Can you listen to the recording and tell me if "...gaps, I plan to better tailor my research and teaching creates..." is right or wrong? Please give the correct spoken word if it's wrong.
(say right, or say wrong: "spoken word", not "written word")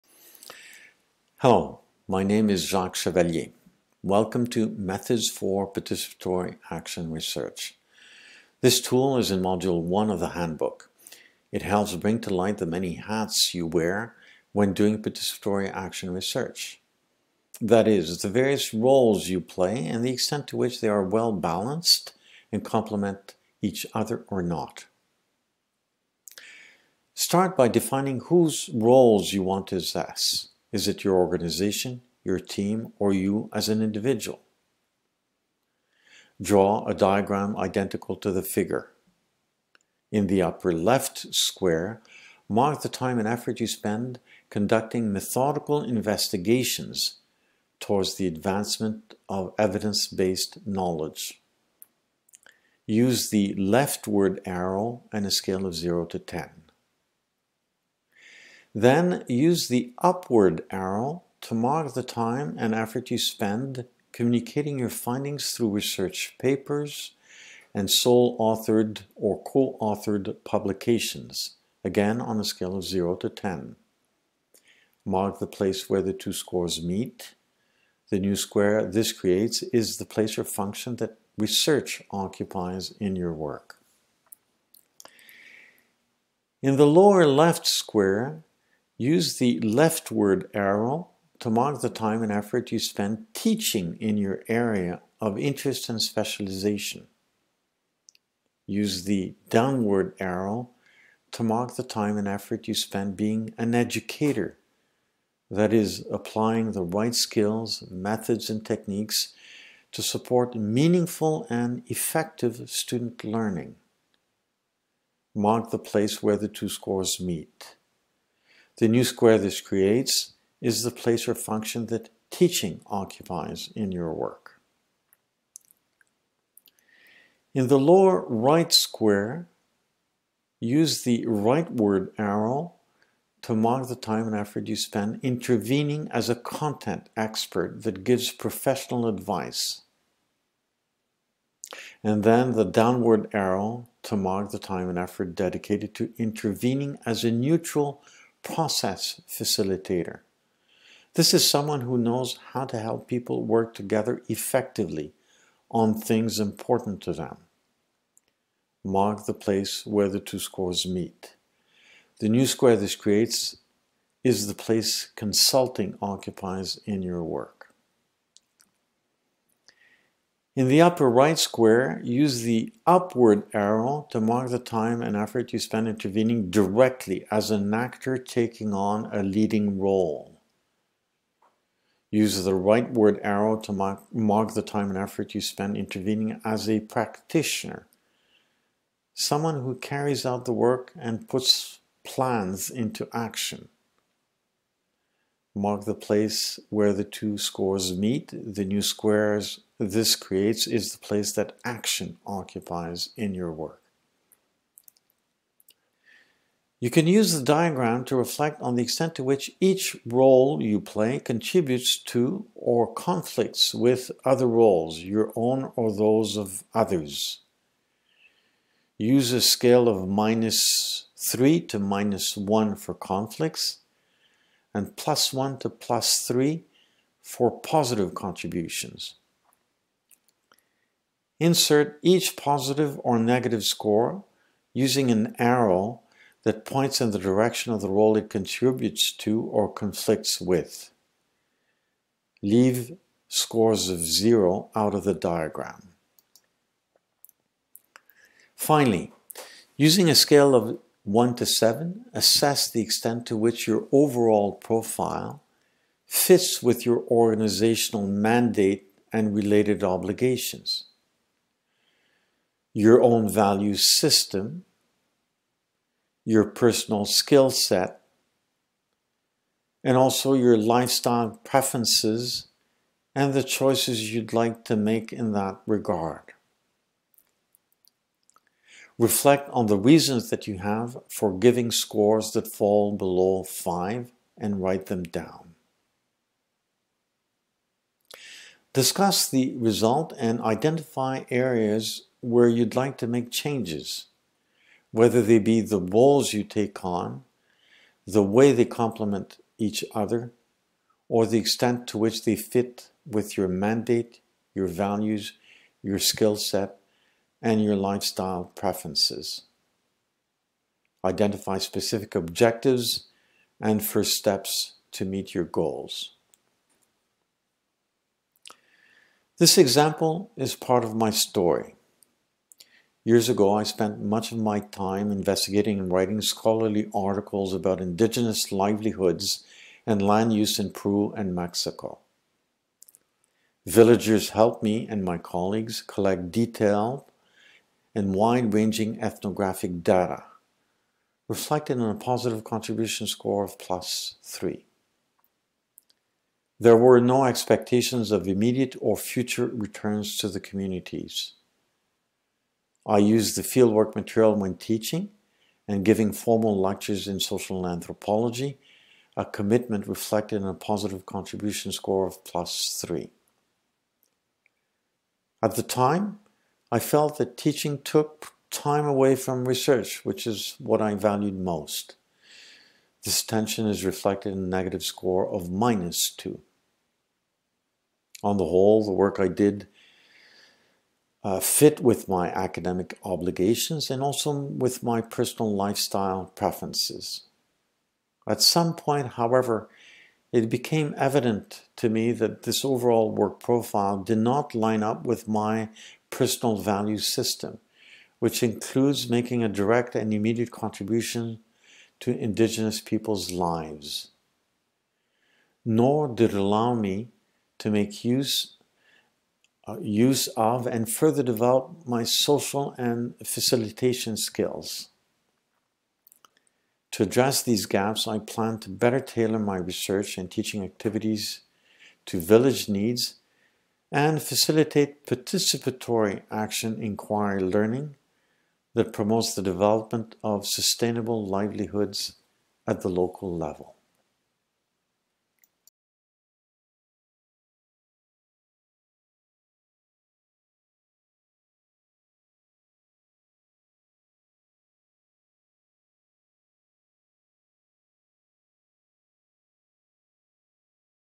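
wrong: "activities", not "creates".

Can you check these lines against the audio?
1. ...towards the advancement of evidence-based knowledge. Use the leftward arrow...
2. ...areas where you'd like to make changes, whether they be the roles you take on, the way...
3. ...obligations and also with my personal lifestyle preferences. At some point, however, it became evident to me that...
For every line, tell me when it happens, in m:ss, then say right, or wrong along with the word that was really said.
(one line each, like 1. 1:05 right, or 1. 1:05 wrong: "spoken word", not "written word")
1. 0:47 right
2. 4:51 right
3. 6:23 right.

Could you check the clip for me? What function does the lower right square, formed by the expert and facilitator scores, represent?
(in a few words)
Consulting.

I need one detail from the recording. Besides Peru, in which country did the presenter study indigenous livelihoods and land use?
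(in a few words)
Mexico.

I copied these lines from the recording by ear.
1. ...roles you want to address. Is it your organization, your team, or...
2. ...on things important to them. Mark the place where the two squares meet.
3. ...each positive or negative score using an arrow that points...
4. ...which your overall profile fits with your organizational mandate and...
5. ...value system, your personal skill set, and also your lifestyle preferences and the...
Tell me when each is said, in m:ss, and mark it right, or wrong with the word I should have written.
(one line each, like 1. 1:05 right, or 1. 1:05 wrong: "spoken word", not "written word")
1. 0:28 wrong: "assess", not "address"
2. 2:35 right
3. 3:52 right
4. 4:13 right
5. 4:23 right.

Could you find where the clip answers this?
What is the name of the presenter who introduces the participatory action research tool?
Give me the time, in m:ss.
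0:02.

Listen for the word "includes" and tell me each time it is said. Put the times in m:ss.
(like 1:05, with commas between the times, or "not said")
6:38.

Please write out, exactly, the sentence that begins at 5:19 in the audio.
This example is part of my story.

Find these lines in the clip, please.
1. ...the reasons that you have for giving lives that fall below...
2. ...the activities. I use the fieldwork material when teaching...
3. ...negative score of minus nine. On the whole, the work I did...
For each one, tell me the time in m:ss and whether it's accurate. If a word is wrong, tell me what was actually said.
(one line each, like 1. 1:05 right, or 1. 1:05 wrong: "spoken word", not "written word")
1. 4:39 wrong: "scores", not "lives"
2. 5:50 wrong: "communities", not "activities"
3. 6:14 wrong: "two", not "nine".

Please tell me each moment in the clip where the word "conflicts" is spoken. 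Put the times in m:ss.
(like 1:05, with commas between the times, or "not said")
3:32, 3:42, 3:59.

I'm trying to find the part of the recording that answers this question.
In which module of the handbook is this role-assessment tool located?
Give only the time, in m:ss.
0:09.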